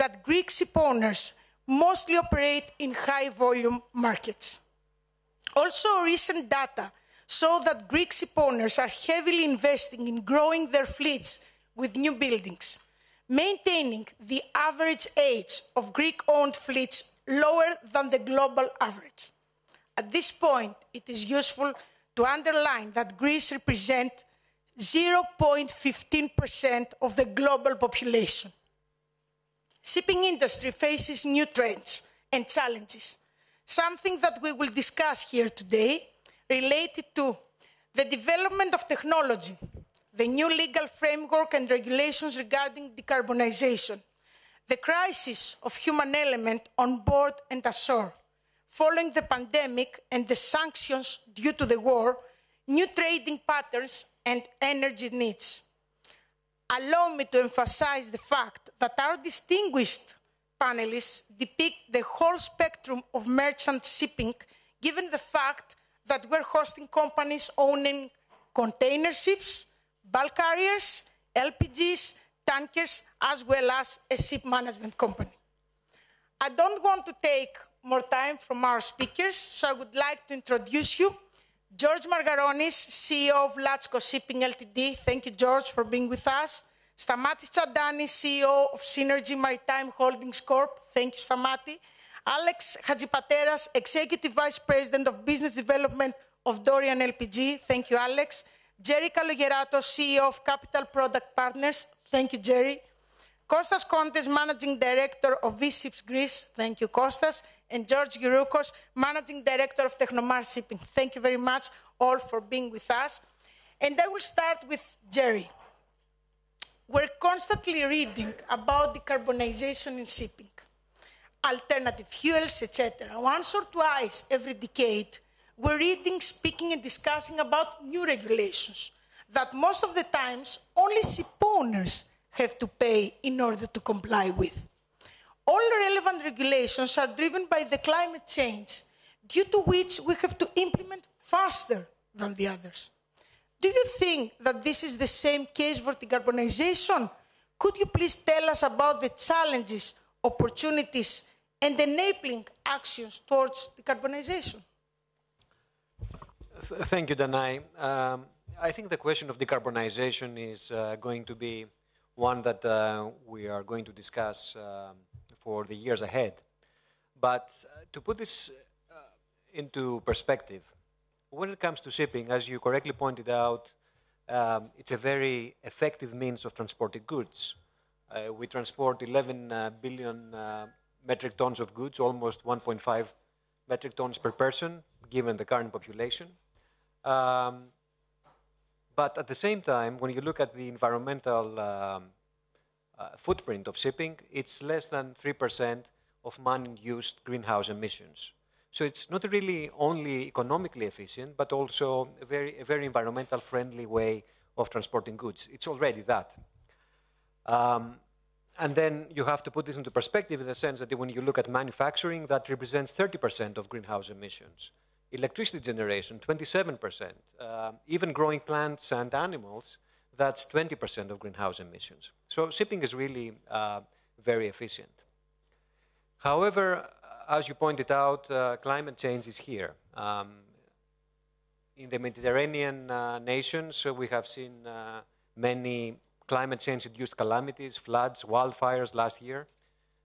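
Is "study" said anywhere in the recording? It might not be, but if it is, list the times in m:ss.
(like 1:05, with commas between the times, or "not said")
not said.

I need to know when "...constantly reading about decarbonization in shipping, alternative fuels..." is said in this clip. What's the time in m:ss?
1:57.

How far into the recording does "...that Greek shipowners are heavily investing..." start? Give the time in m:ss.
0:07.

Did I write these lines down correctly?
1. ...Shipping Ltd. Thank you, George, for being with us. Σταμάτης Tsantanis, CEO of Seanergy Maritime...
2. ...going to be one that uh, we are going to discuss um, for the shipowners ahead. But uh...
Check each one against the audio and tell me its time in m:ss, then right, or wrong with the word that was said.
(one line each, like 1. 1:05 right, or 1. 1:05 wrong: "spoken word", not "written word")
1. 1:24 right
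2. 2:40 wrong: "years", not "shipowners".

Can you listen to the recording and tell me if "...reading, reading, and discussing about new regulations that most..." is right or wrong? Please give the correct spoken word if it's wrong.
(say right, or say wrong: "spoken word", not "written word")
wrong: "speaking", not "reading".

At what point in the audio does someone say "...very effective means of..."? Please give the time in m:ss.
2:54.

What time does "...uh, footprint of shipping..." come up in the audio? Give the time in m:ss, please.
3:12.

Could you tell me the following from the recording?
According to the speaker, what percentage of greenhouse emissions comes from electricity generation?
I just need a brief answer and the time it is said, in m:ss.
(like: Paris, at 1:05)
27%, at 3:36.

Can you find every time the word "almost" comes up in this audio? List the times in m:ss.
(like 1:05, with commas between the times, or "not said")
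3:01.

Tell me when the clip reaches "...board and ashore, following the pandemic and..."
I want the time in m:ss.
0:47.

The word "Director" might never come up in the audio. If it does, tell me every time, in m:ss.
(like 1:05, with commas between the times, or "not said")
1:44, 1:49.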